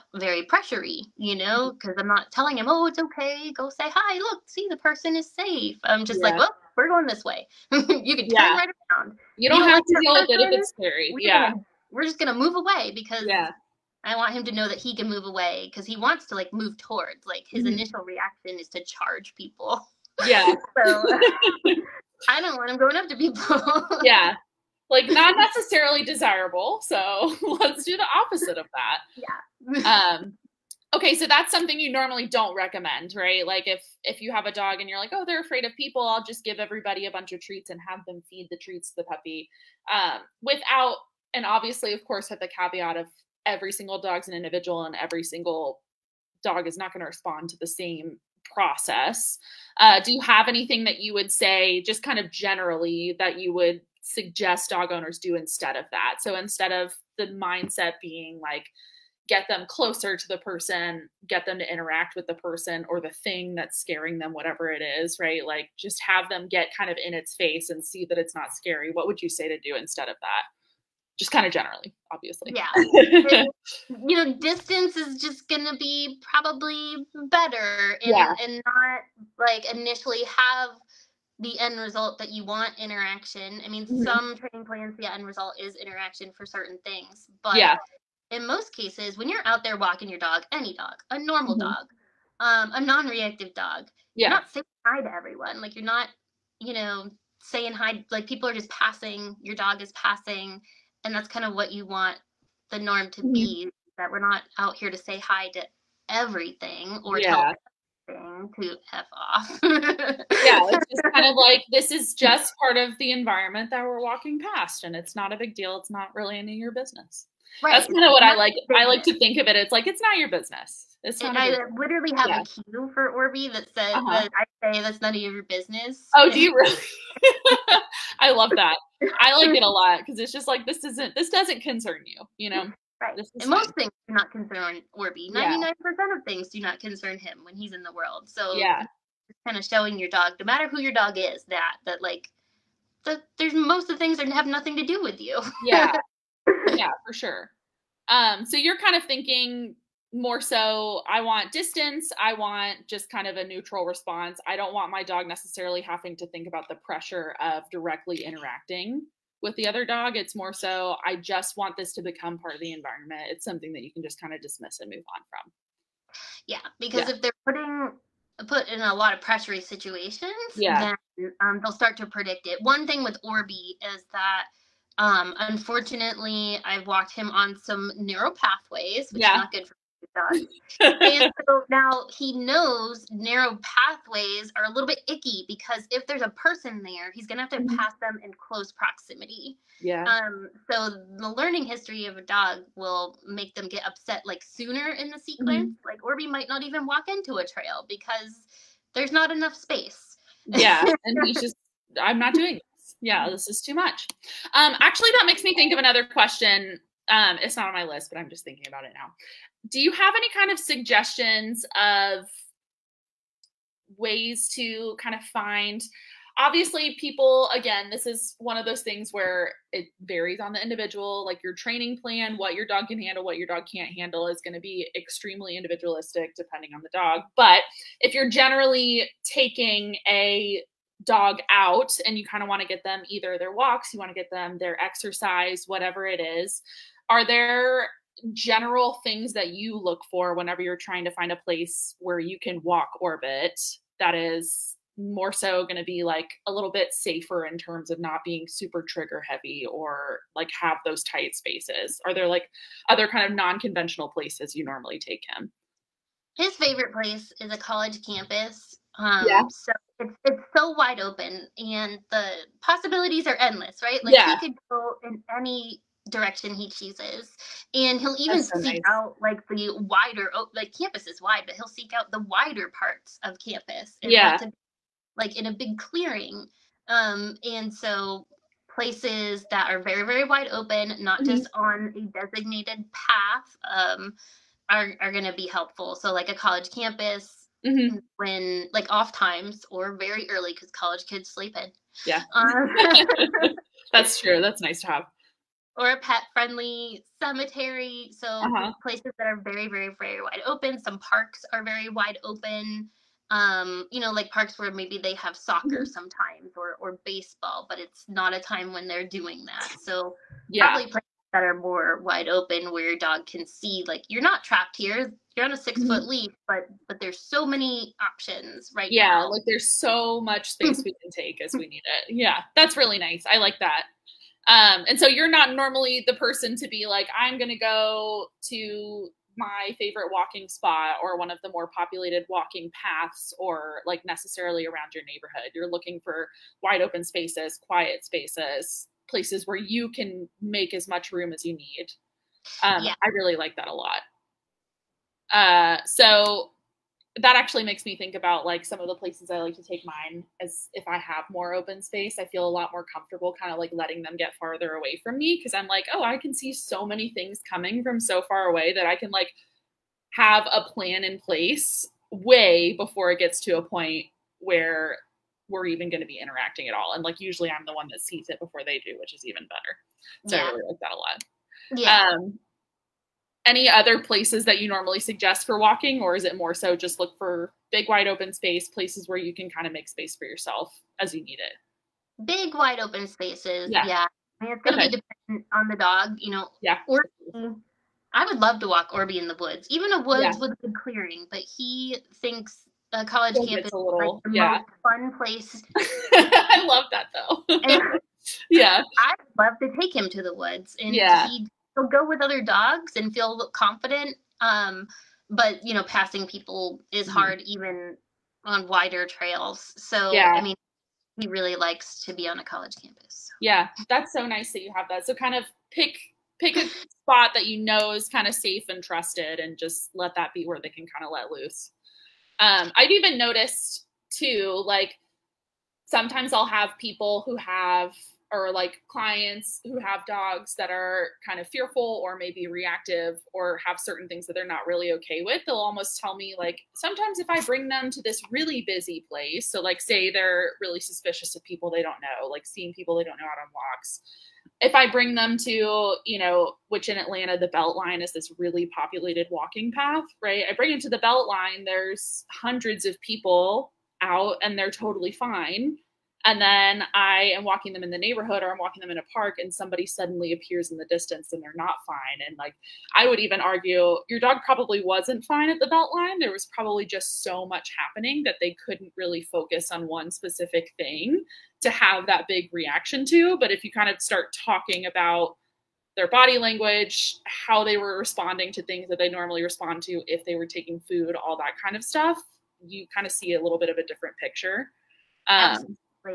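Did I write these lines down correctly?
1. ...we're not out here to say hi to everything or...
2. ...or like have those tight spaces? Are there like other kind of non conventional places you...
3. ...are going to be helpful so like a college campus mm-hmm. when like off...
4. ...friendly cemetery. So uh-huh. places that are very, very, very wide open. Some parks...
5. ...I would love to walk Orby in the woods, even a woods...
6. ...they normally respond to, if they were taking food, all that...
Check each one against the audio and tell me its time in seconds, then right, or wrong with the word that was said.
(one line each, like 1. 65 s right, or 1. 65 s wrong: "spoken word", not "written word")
1. 104 s right
2. 249 s right
3. 285 s right
4. 296 s right
5. 388 s right
6. 478 s right.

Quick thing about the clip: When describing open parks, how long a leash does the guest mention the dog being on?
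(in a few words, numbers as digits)
6 feet.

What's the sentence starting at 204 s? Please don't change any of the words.
Um, actually, that makes me think of another question.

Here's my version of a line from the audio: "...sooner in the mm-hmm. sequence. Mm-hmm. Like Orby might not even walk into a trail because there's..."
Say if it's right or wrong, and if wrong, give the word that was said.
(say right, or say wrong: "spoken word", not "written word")
right.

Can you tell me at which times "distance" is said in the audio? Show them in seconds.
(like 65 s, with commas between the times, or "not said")
74 s, 151 s, 460 s.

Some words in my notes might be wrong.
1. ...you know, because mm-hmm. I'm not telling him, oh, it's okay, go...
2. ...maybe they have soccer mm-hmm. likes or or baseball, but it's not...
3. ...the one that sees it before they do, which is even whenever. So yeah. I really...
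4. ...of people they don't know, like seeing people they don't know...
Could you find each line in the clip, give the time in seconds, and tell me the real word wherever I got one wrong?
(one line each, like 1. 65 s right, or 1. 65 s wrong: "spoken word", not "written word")
1. 1 s right
2. 304 s wrong: "sometimes", not "likes"
3. 367 s wrong: "better", not "whenever"
4. 441 s right.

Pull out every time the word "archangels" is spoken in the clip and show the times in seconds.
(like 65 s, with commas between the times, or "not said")
not said.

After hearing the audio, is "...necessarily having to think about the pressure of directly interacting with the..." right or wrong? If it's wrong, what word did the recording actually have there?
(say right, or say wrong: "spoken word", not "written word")
right.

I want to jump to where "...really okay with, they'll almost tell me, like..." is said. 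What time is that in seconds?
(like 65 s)
434 s.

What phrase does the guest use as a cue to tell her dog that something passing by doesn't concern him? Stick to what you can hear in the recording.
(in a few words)
That's none of your business.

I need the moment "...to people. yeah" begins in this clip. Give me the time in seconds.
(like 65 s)
23 s.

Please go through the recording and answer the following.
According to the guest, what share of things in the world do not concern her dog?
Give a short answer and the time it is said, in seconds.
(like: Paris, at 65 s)
99 percent, at 135 s.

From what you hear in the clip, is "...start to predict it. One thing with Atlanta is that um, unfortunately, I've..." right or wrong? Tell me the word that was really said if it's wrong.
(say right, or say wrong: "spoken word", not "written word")
wrong: "Orby", not "Atlanta".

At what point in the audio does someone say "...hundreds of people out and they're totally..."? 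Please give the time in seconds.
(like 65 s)
452 s.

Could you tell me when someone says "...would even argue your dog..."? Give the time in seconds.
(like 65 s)
463 s.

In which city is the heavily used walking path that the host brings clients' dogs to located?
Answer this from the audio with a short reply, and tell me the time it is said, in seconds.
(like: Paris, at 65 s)
Atlanta, at 446 s.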